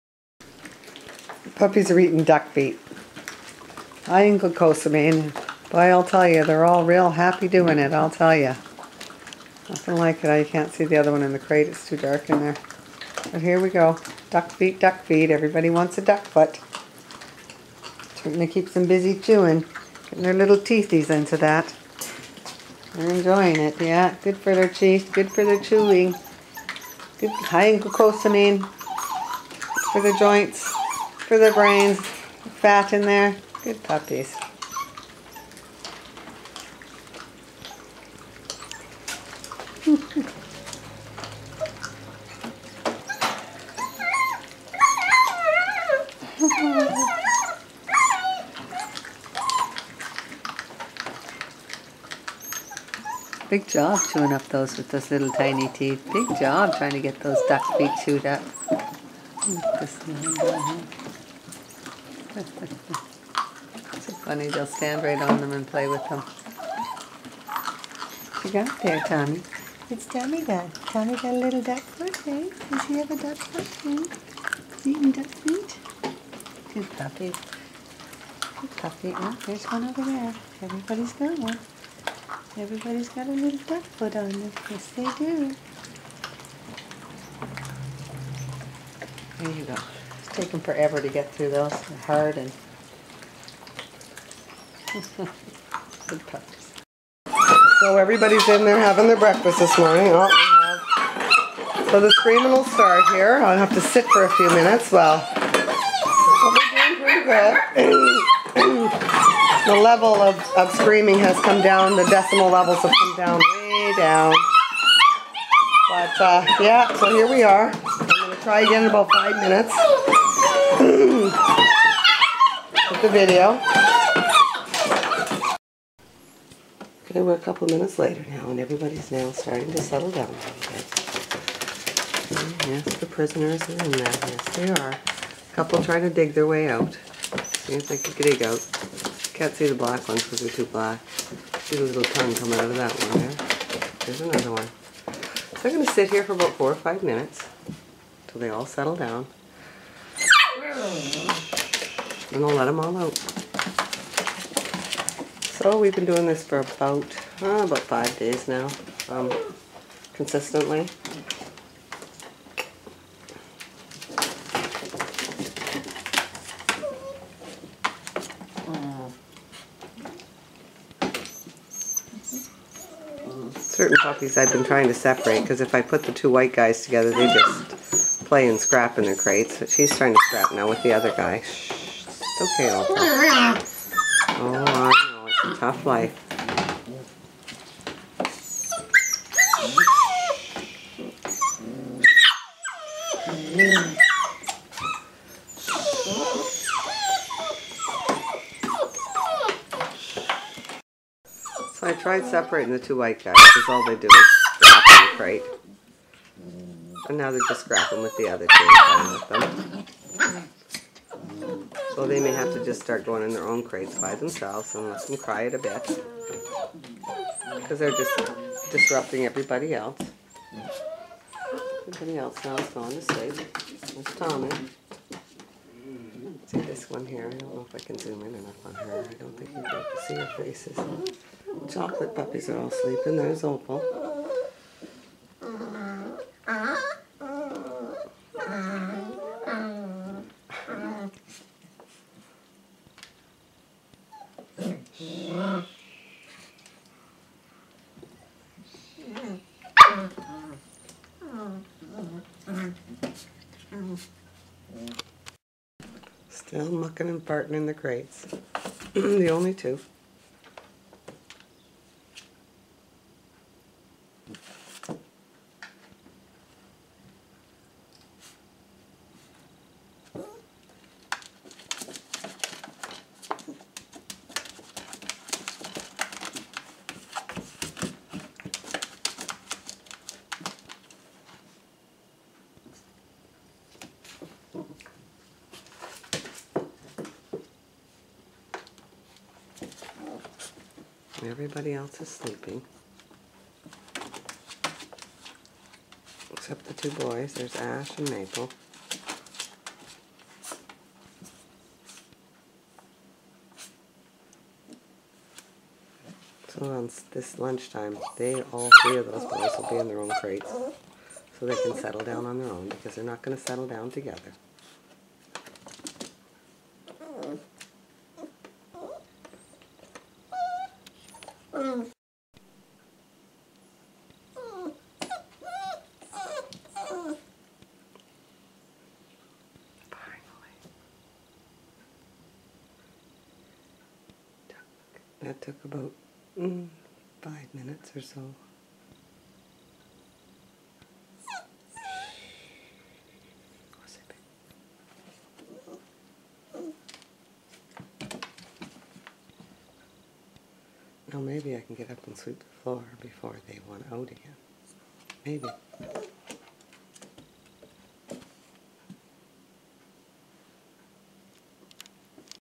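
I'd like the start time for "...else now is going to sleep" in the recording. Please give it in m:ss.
3:42.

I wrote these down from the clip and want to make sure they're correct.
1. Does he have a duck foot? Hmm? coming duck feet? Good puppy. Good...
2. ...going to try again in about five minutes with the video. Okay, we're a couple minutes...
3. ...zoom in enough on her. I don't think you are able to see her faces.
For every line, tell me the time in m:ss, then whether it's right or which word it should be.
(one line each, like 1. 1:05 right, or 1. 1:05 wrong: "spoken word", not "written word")
1. 1:12 wrong: "eating", not "coming"
2. 1:58 right
3. 3:47 right.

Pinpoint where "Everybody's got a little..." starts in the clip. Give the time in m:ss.
1:22.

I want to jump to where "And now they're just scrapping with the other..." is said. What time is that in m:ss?
3:27.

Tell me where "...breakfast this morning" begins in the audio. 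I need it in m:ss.
1:39.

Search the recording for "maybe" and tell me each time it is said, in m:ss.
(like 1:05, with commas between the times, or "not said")
5:51, 5:55.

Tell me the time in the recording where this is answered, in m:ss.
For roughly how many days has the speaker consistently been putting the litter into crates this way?
2:37.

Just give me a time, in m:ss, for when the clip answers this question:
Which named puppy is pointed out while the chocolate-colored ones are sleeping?
3:53.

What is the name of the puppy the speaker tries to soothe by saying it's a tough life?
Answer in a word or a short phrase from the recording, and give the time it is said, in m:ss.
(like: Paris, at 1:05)
Alta, at 3:02.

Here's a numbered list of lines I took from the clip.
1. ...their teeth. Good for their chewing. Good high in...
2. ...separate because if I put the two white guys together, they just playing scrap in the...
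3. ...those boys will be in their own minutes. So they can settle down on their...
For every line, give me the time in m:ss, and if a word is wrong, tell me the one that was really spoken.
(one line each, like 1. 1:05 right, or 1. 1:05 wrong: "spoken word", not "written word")
1. 0:24 right
2. 2:54 right
3. 5:09 wrong: "crates", not "minutes".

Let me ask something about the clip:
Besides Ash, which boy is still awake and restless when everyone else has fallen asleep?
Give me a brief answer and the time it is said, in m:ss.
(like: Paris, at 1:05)
Maple, at 4:58.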